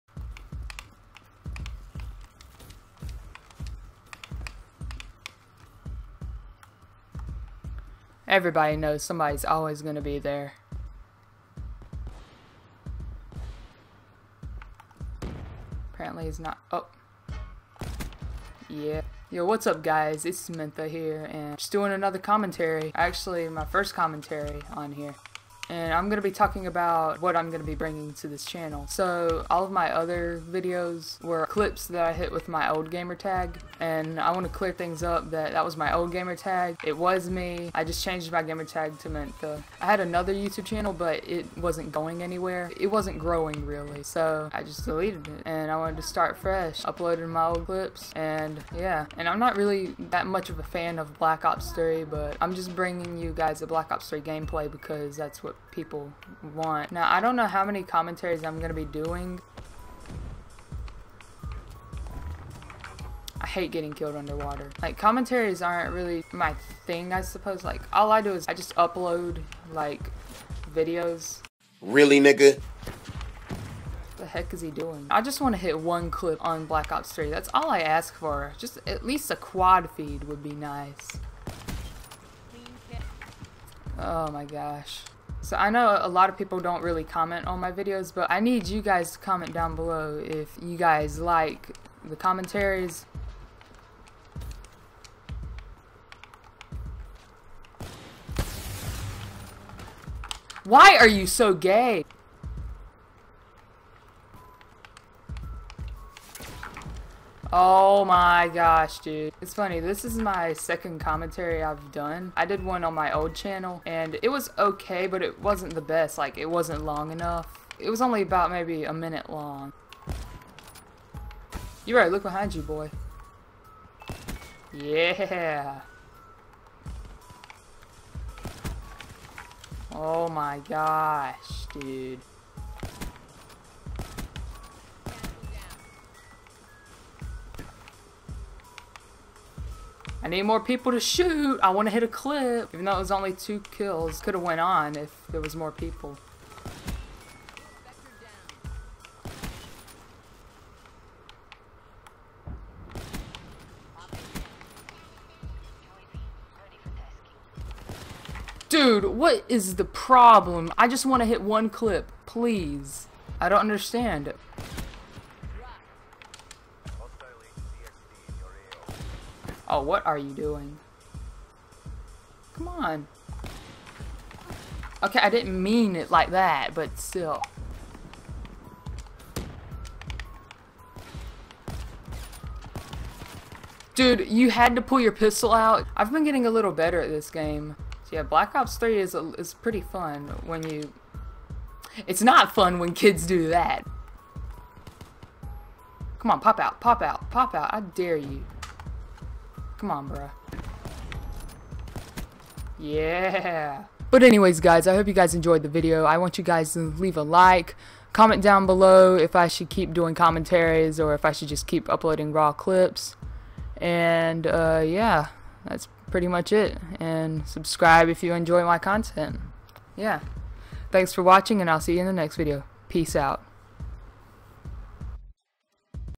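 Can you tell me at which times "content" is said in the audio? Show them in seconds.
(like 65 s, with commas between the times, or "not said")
218 s.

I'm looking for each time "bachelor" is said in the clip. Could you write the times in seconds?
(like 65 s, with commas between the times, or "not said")
not said.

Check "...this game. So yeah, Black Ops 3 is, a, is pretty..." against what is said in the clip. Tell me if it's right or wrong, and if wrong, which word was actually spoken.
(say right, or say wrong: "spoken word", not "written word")
right.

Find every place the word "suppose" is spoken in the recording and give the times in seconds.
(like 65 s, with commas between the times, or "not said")
67 s.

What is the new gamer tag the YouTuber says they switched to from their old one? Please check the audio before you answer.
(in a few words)
Mentha.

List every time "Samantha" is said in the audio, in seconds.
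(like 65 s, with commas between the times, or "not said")
20 s.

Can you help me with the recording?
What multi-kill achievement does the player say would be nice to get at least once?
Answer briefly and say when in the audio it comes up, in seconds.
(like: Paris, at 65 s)
quad feed, at 79 s.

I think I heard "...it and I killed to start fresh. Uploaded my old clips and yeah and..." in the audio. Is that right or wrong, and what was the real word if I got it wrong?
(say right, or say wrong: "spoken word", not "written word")
wrong: "wanted", not "killed".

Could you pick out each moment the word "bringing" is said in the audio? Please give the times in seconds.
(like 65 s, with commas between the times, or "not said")
27 s, 52 s.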